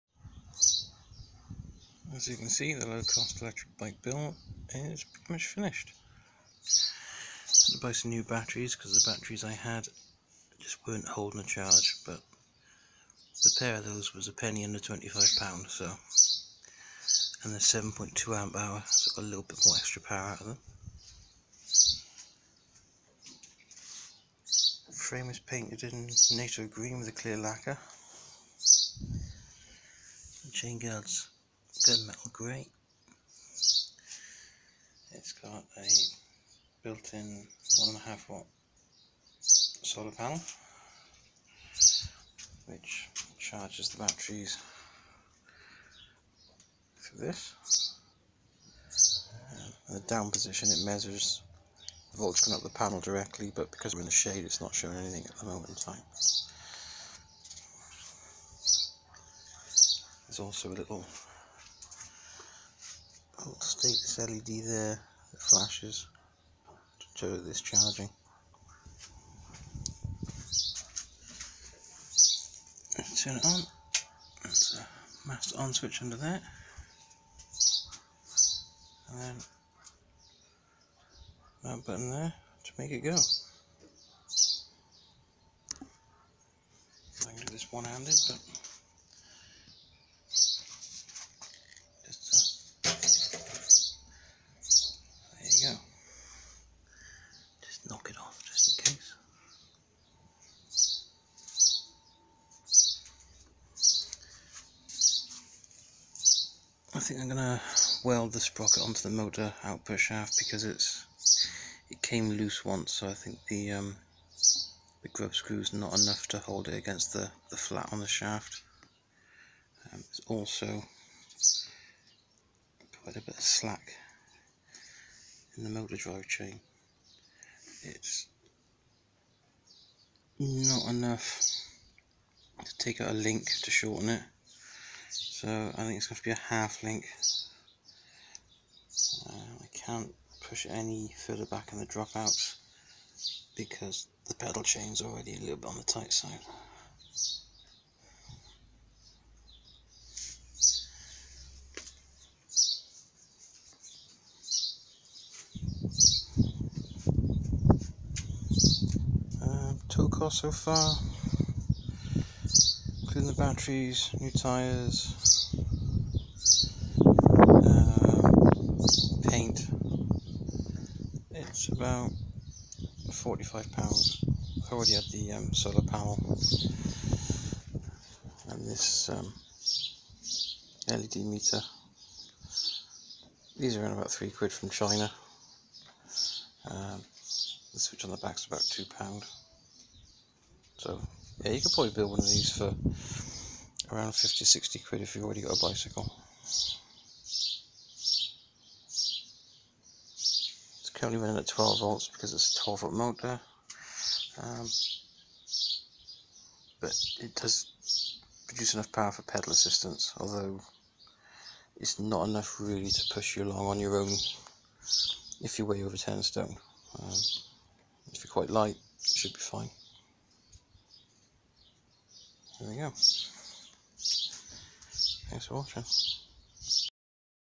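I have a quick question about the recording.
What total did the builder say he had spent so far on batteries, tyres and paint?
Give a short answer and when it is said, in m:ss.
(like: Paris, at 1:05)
£45, at 2:53.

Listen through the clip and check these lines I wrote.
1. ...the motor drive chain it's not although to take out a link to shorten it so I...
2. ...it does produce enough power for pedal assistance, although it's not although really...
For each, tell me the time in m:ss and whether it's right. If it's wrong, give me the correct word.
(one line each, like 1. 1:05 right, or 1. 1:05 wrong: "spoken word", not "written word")
1. 2:05 wrong: "enough", not "although"
2. 3:27 wrong: "enough", not "although".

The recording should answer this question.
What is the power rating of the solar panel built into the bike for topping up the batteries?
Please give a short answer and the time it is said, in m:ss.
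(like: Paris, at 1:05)
1.5 watt, at 0:37.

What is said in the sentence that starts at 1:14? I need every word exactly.
There's a master on switch under there.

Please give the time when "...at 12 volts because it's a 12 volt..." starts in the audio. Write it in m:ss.
3:21.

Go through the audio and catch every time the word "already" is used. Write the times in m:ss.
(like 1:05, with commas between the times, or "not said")
2:25, 2:54, 3:15.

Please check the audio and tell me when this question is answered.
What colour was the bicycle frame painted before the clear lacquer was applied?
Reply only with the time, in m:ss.
0:26.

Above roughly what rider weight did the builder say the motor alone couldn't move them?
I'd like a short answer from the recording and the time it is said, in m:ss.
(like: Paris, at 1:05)
10 stone, at 3:35.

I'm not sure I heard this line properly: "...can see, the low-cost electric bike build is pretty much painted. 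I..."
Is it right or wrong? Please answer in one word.
wrong.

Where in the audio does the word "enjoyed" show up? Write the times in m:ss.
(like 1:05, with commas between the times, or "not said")
not said.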